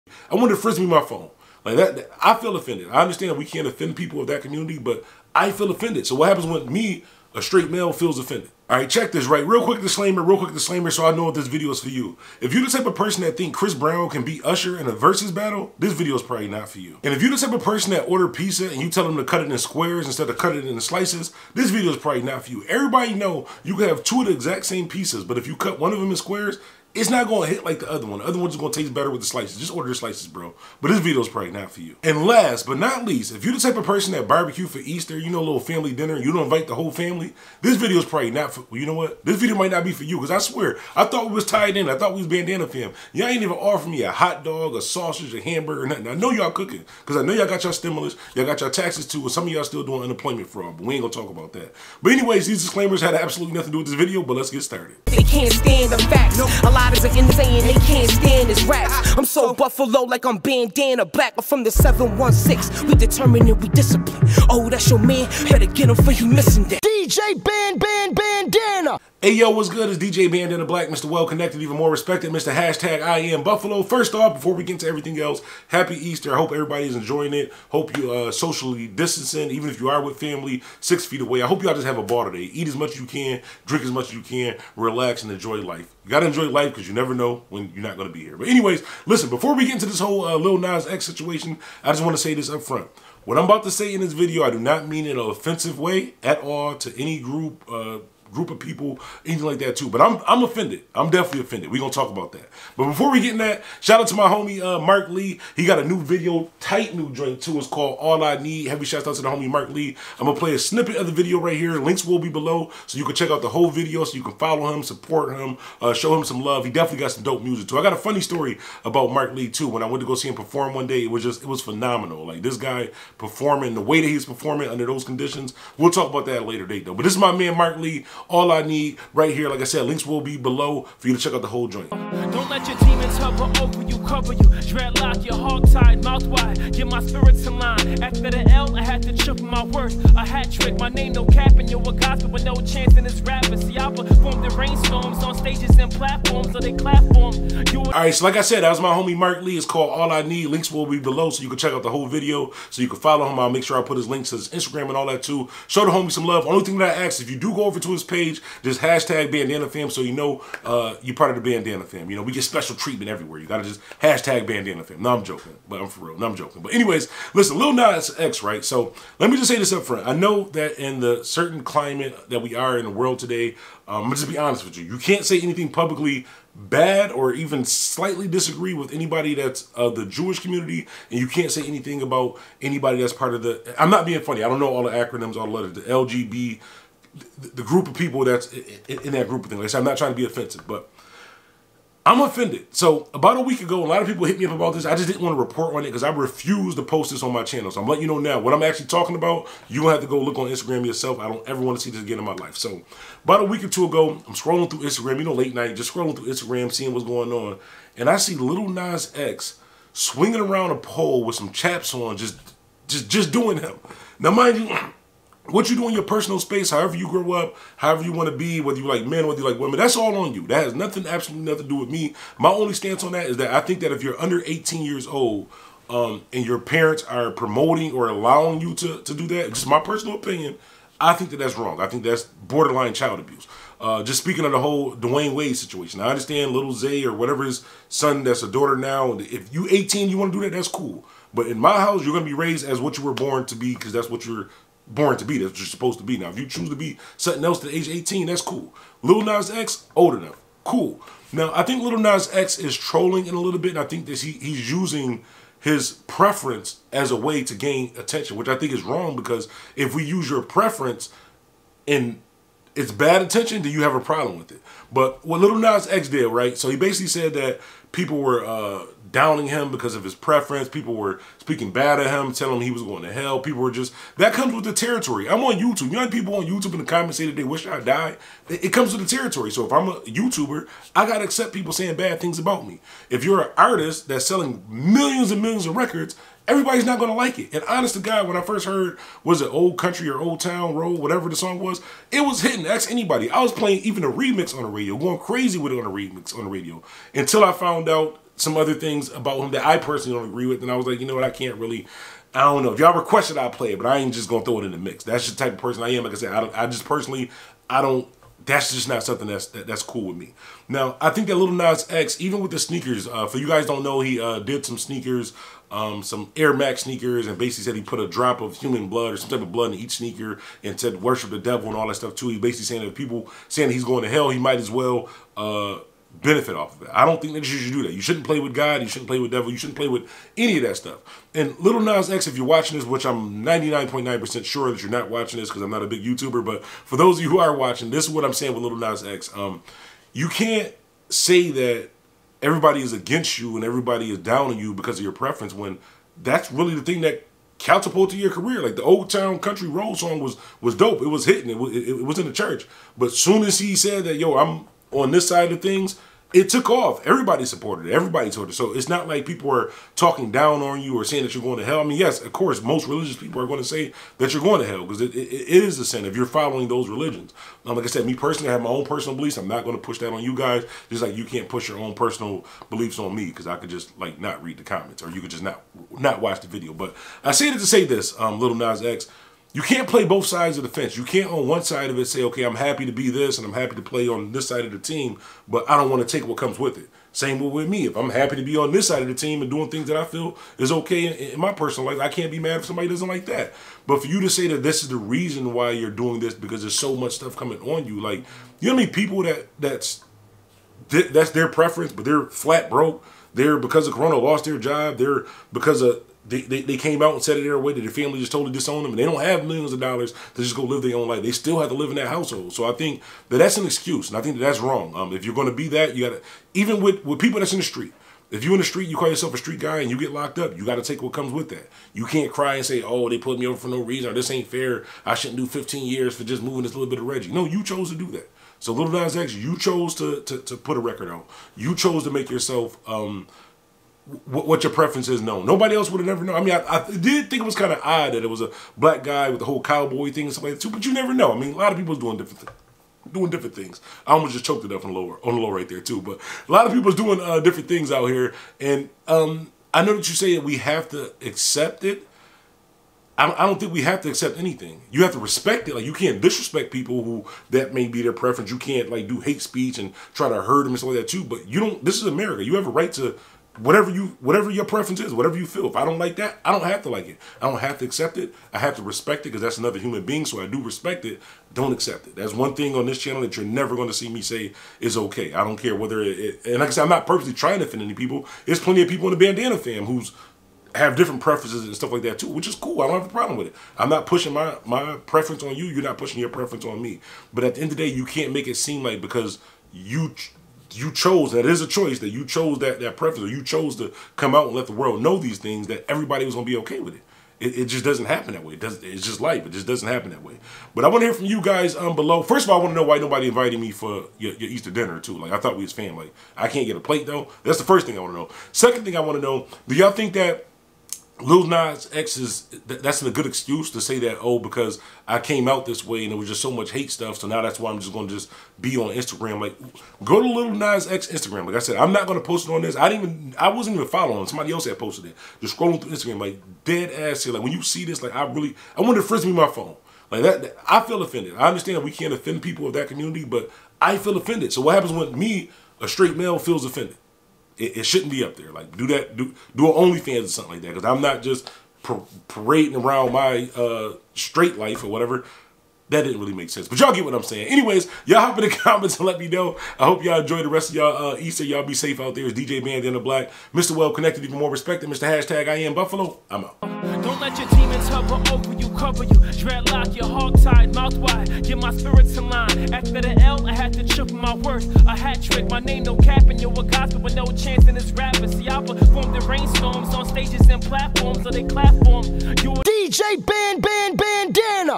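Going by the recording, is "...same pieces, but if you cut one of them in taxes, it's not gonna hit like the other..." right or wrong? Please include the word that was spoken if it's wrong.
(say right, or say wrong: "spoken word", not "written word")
wrong: "squares", not "taxes".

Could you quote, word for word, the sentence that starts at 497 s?
It, it just doesn't happen that way.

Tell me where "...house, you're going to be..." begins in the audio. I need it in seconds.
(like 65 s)
241 s.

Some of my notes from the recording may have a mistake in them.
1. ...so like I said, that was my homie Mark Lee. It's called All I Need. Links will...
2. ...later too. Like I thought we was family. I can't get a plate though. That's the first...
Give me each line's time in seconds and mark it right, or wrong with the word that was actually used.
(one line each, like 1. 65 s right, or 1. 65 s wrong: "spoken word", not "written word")
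1. 148 s right
2. 504 s wrong: "dinner", not "later".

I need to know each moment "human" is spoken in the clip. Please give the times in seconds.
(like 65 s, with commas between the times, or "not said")
318 s, 469 s.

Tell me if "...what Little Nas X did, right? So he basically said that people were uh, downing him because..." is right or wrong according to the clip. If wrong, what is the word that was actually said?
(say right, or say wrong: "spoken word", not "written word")
right.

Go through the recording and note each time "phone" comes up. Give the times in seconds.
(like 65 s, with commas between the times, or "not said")
1 s, 529 s.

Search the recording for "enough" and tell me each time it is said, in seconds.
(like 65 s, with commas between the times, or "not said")
250 s.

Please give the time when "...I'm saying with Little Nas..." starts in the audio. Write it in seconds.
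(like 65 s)
338 s.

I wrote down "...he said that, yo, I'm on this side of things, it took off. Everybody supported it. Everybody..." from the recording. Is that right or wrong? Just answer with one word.
right.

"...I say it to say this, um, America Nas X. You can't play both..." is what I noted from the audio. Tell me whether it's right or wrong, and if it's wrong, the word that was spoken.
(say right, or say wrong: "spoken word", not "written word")
wrong: "Little", not "America".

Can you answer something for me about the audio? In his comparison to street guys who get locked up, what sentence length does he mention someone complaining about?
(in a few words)
15 years.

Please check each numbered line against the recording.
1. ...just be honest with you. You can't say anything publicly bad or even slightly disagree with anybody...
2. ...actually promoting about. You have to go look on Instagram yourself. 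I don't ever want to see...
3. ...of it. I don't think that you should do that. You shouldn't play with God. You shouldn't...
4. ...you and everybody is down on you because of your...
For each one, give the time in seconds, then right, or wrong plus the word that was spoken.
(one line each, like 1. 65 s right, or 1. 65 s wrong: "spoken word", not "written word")
1. 174 s right
2. 198 s wrong: "talking", not "promoting"
3. 326 s right
4. 343 s right.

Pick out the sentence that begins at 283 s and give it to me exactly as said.
If you're an artist that's selling millions and millions of records, everybody's not gonna like it.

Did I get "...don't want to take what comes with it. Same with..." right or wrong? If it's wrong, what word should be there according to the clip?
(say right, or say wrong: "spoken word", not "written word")
right.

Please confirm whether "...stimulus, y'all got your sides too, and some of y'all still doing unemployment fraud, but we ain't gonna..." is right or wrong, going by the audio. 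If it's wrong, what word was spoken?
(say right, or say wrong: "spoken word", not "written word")
wrong: "taxes", not "sides".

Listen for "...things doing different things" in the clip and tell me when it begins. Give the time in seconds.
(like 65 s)
442 s.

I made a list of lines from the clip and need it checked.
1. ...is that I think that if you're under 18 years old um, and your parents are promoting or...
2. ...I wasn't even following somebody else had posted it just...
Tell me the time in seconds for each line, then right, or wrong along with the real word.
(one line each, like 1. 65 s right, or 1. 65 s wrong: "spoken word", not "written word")
1. 223 s right
2. 523 s right.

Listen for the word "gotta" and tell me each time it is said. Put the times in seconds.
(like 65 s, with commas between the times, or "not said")
86 s, 163 s.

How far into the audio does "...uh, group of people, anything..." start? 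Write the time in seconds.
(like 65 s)
97 s.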